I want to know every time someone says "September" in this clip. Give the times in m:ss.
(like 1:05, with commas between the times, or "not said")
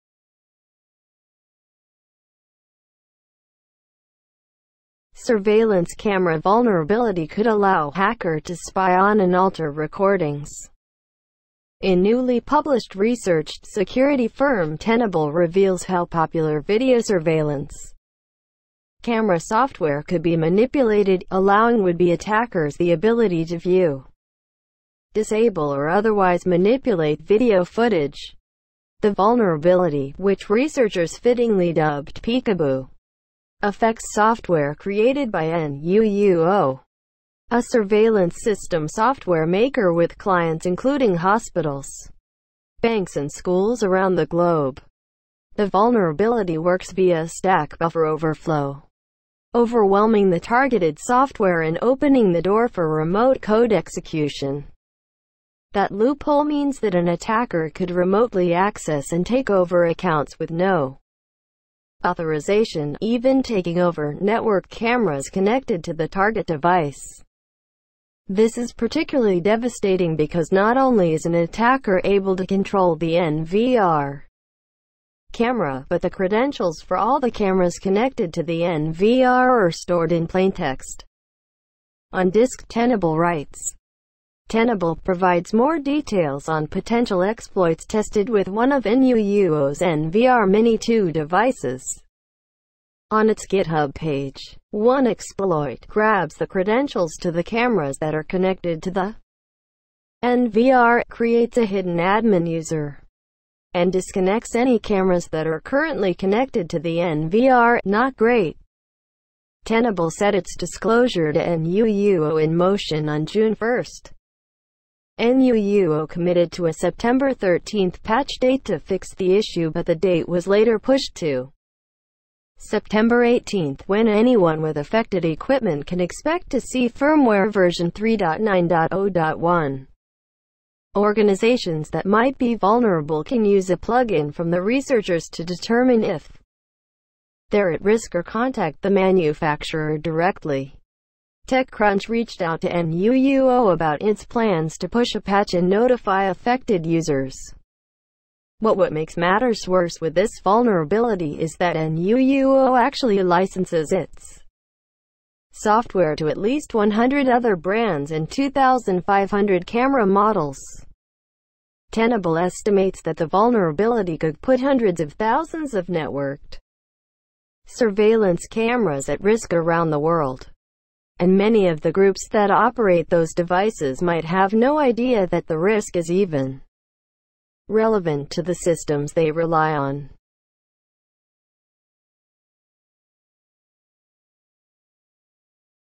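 1:56, 2:02.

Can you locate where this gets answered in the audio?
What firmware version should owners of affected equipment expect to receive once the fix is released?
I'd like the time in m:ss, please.
2:07.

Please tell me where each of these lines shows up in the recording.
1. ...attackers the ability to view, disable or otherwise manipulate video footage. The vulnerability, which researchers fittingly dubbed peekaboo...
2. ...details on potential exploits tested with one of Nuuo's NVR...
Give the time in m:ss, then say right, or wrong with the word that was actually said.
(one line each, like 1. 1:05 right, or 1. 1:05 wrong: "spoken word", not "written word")
1. 0:22 right
2. 1:25 right.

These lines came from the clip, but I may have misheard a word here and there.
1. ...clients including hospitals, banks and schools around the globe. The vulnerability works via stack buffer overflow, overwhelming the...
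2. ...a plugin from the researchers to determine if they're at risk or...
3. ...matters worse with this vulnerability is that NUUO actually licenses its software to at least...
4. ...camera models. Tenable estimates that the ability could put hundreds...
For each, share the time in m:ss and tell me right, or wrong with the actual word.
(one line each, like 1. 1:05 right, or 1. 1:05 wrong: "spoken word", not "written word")
1. 0:40 right
2. 2:13 right
3. 2:29 right
4. 2:39 wrong: "vulnerability", not "ability".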